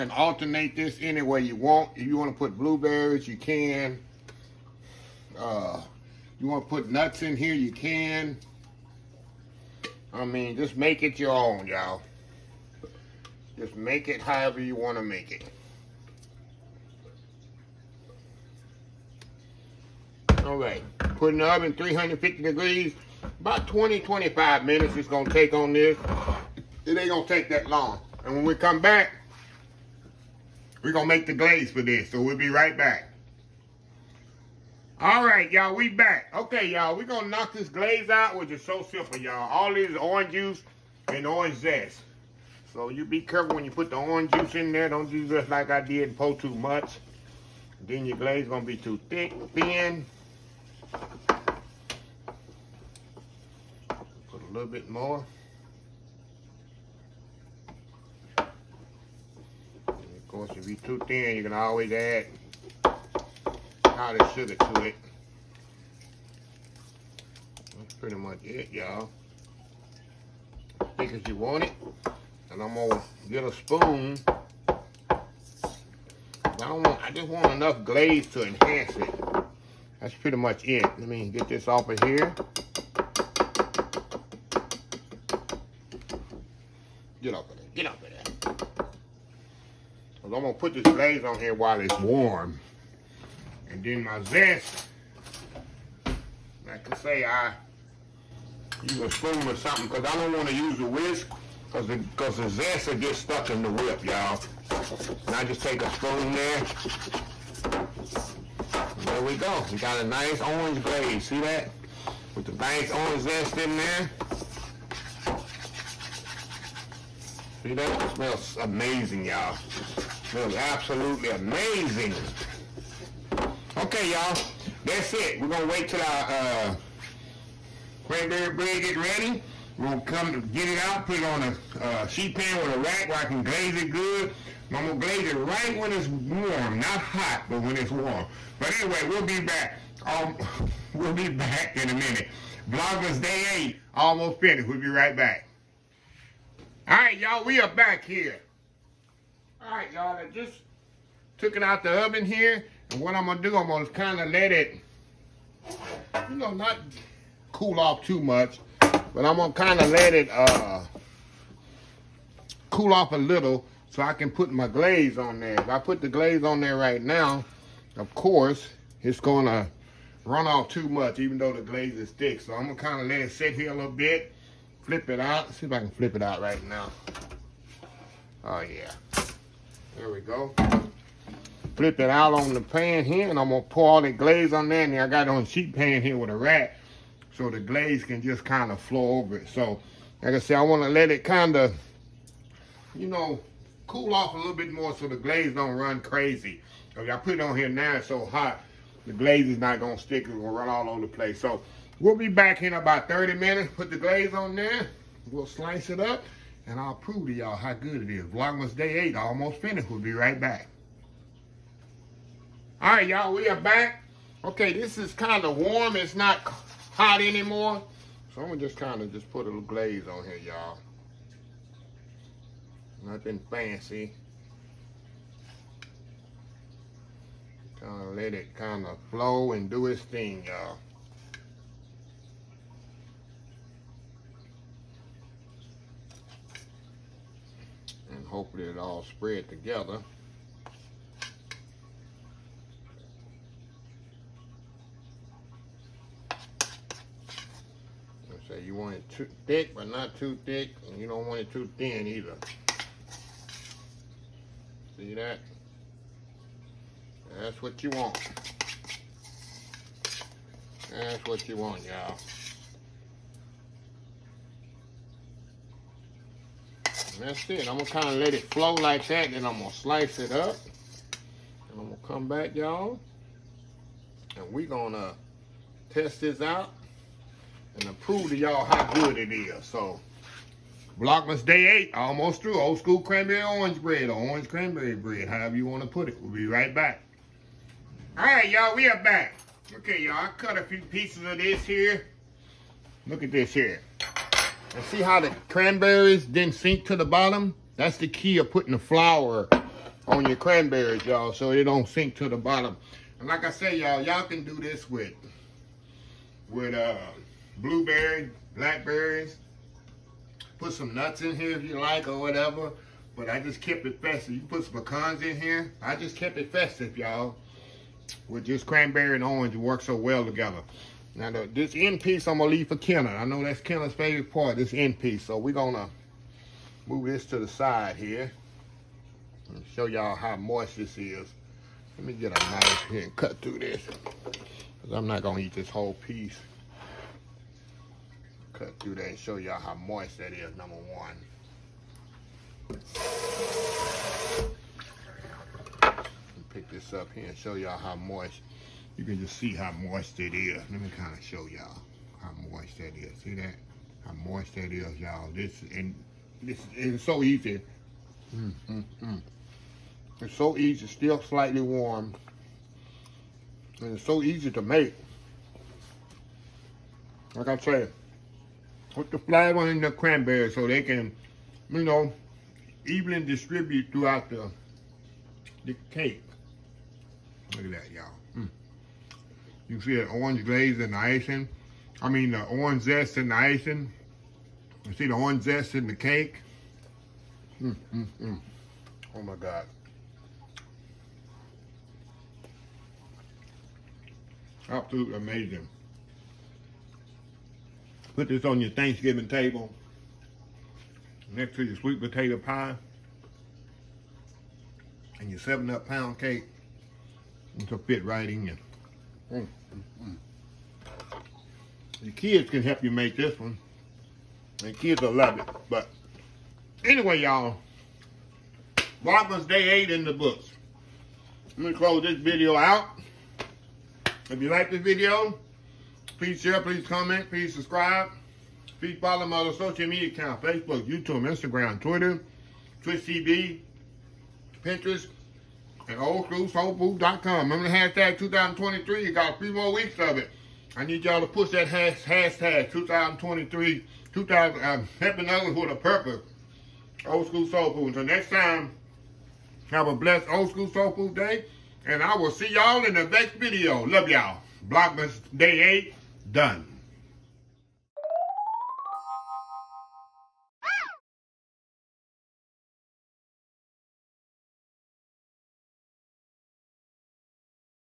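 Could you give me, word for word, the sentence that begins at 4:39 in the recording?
So, Vlogmas Day 8, almost through.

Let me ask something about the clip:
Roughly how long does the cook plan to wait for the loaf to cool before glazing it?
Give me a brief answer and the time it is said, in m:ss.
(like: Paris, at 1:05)
30 minutes, at 3:22.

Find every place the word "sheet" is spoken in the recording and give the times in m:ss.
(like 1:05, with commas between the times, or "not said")
2:12, 3:05.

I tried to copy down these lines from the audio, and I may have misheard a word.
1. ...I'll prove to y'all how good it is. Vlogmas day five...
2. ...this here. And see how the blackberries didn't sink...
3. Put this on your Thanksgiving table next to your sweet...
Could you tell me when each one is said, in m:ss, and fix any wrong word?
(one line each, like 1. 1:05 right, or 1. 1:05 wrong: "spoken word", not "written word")
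1. 3:26 wrong: "eight", not "five"
2. 4:53 wrong: "cranberries", not "blackberries"
3. 6:38 right.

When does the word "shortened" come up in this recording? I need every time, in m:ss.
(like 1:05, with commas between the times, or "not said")
not said.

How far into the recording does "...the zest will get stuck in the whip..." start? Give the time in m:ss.
1:42.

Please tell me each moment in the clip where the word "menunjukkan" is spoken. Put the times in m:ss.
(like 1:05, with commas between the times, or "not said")
not said.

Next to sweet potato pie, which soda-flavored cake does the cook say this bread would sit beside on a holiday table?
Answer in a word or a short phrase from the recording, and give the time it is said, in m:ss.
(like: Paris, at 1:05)
7-Up pound cake, at 6:45.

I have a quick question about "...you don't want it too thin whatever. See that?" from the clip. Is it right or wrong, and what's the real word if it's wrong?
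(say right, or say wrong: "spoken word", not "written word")
wrong: "either", not "whatever".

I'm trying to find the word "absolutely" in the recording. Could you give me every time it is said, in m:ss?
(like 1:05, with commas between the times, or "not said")
2:00, 6:34.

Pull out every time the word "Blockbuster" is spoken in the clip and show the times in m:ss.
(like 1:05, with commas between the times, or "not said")
7:34.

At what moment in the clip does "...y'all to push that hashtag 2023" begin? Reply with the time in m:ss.
7:21.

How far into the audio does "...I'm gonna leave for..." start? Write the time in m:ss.
5:22.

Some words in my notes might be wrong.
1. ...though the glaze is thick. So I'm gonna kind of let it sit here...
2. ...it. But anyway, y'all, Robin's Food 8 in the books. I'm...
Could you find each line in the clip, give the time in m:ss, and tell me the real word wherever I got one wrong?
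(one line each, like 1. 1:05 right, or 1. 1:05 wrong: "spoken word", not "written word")
1. 2:51 right
2. 6:55 wrong: "Day", not "Food".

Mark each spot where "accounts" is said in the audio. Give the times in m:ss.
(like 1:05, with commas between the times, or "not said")
7:10.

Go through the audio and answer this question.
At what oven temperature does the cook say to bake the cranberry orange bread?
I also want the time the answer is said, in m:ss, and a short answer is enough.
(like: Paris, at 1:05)
350 degrees, at 0:21.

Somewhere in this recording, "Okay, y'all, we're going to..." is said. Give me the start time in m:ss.
0:36.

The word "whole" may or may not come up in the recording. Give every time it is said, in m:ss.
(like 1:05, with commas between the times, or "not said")
5:35.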